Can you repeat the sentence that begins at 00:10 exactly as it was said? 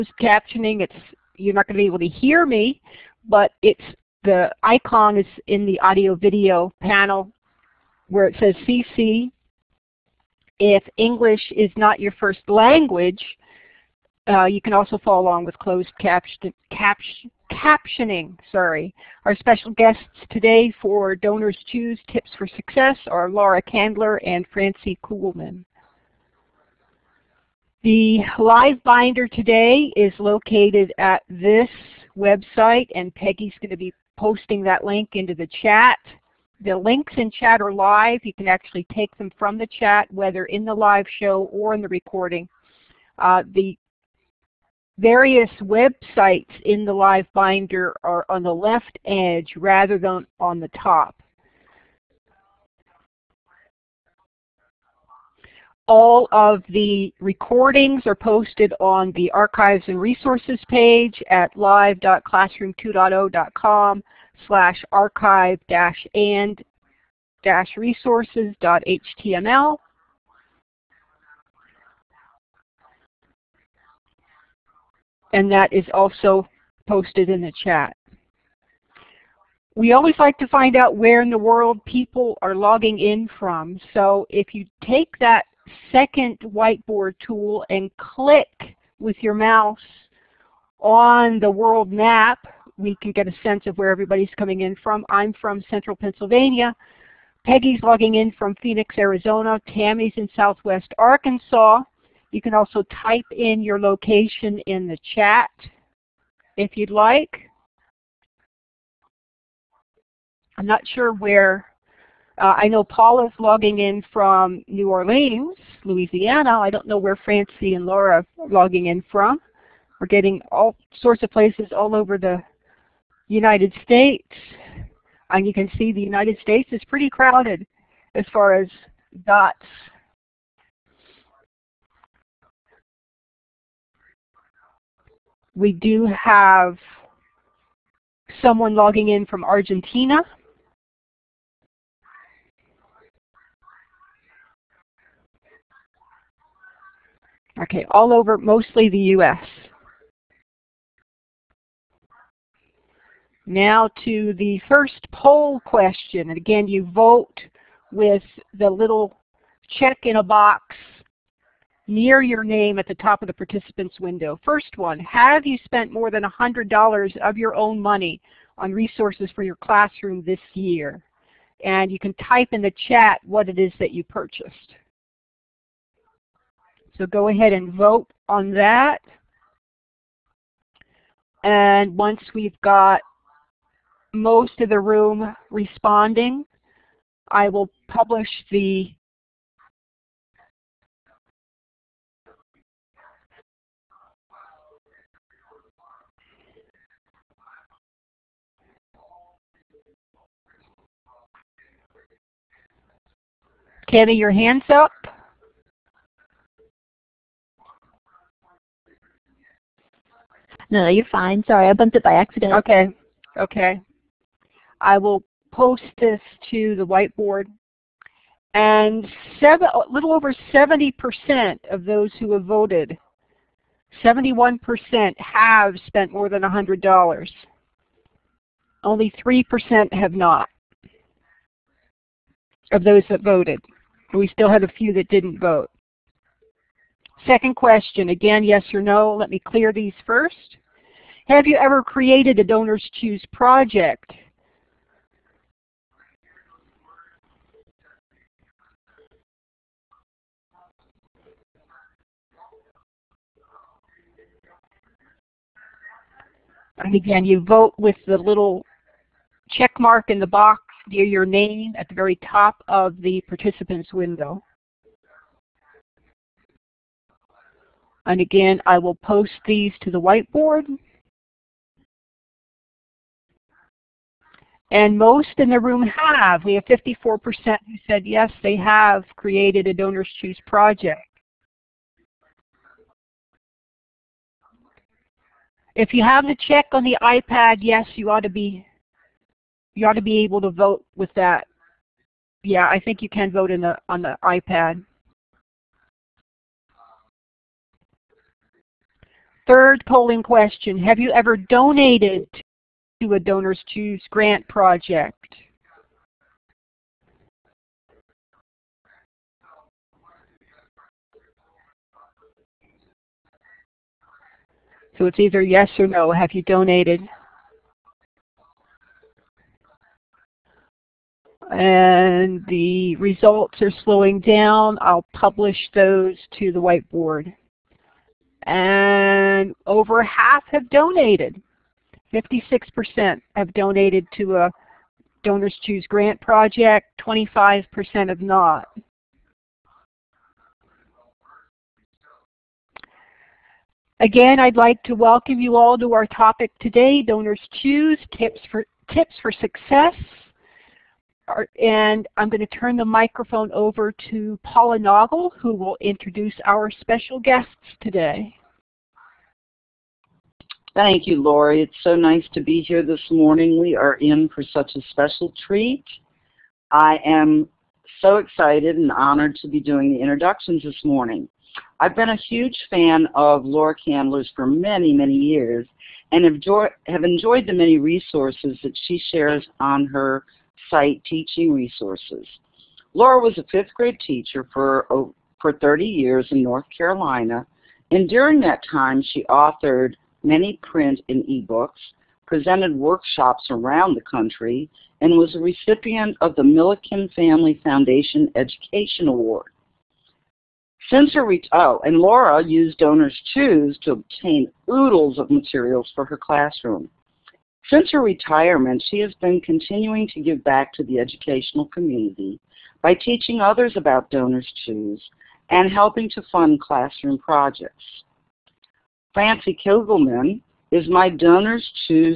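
If English is not your first language, uh, you can also follow along with closed caption, captioning.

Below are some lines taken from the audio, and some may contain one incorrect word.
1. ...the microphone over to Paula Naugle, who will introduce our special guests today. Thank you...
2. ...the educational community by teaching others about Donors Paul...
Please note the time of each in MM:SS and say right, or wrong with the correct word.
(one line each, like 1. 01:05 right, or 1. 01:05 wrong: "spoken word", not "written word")
1. 05:52 right
2. 06:50 wrong: "Choose", not "Paul".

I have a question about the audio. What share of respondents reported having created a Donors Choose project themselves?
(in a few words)
54%.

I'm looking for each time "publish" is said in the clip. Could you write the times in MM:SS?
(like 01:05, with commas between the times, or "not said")
03:07, 05:25.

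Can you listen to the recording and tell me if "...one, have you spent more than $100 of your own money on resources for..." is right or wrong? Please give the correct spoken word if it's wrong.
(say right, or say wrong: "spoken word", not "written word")
right.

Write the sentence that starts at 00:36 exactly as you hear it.
The links in chat are live.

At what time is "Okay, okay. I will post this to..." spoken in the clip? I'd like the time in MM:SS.
03:32.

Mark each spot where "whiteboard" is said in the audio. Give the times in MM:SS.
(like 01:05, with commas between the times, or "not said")
01:26, 03:36, 04:30, 05:26.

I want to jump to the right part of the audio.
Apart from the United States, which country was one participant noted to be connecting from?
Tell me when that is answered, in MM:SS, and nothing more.
02:19.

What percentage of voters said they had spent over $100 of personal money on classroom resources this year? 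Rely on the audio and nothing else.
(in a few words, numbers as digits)
71%.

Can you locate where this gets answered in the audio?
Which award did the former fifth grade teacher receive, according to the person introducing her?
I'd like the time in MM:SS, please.
06:36.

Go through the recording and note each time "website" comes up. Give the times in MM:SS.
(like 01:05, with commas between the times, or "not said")
00:32, 00:45.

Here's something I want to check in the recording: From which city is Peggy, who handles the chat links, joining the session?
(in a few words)
Phoenix, Arizona.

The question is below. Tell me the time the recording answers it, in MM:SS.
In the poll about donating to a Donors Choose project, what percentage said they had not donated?
05:37.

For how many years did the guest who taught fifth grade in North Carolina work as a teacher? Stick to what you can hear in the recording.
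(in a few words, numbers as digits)
30.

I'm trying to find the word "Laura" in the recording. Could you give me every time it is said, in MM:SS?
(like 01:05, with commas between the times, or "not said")
00:23, 01:57, 06:13, 06:22, 06:41.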